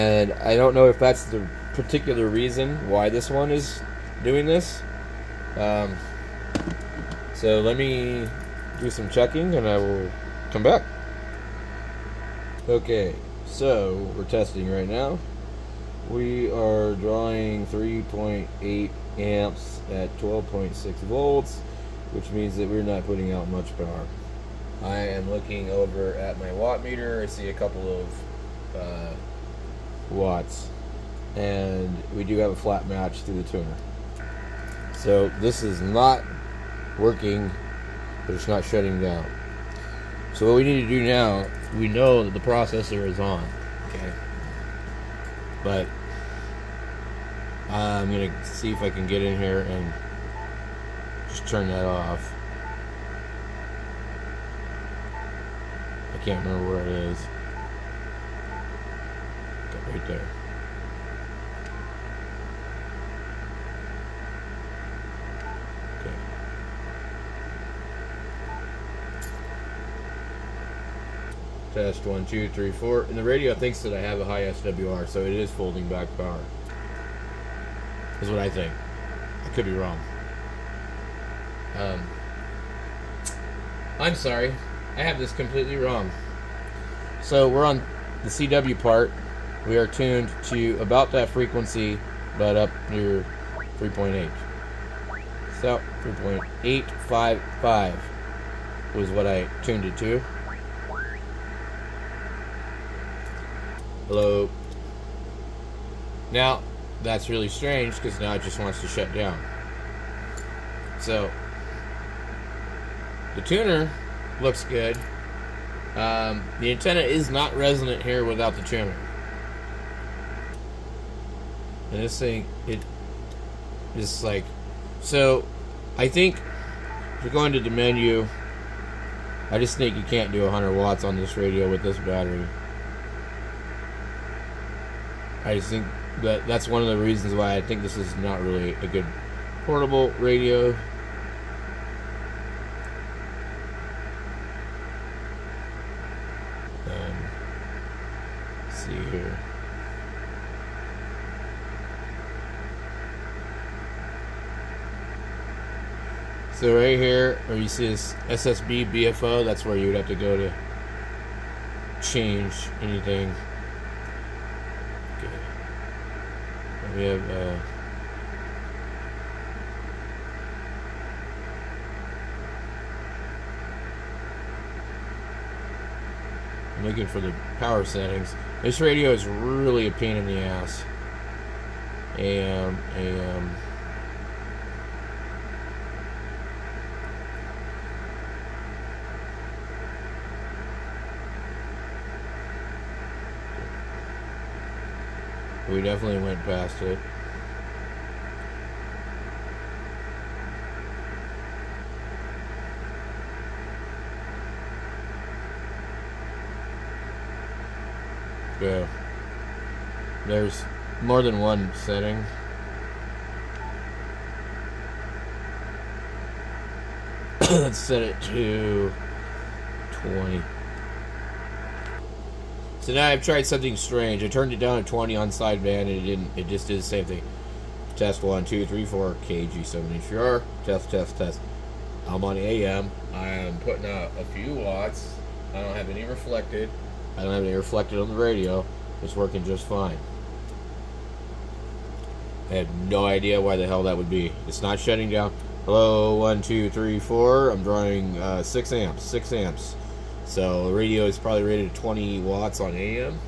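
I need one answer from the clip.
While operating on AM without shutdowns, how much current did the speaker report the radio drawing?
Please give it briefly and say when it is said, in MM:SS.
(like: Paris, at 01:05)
6 amps, at 04:08.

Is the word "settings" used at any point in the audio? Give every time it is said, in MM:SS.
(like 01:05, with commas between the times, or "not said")
02:57, 03:31.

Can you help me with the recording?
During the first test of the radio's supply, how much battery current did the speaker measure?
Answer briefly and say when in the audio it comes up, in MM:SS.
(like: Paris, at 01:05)
3.8 amps, at 00:17.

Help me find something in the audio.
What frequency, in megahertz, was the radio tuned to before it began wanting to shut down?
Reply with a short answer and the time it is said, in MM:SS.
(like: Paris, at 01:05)
3.855, at 01:36.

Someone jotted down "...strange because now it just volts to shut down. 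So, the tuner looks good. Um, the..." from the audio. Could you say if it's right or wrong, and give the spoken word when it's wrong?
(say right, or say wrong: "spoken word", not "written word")
wrong: "wants", not "volts".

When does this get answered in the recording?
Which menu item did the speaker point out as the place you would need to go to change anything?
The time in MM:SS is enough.
02:38.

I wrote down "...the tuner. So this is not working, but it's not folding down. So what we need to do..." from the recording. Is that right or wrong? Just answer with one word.
wrong.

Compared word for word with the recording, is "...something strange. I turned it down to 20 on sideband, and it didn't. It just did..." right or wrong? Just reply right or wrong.
right.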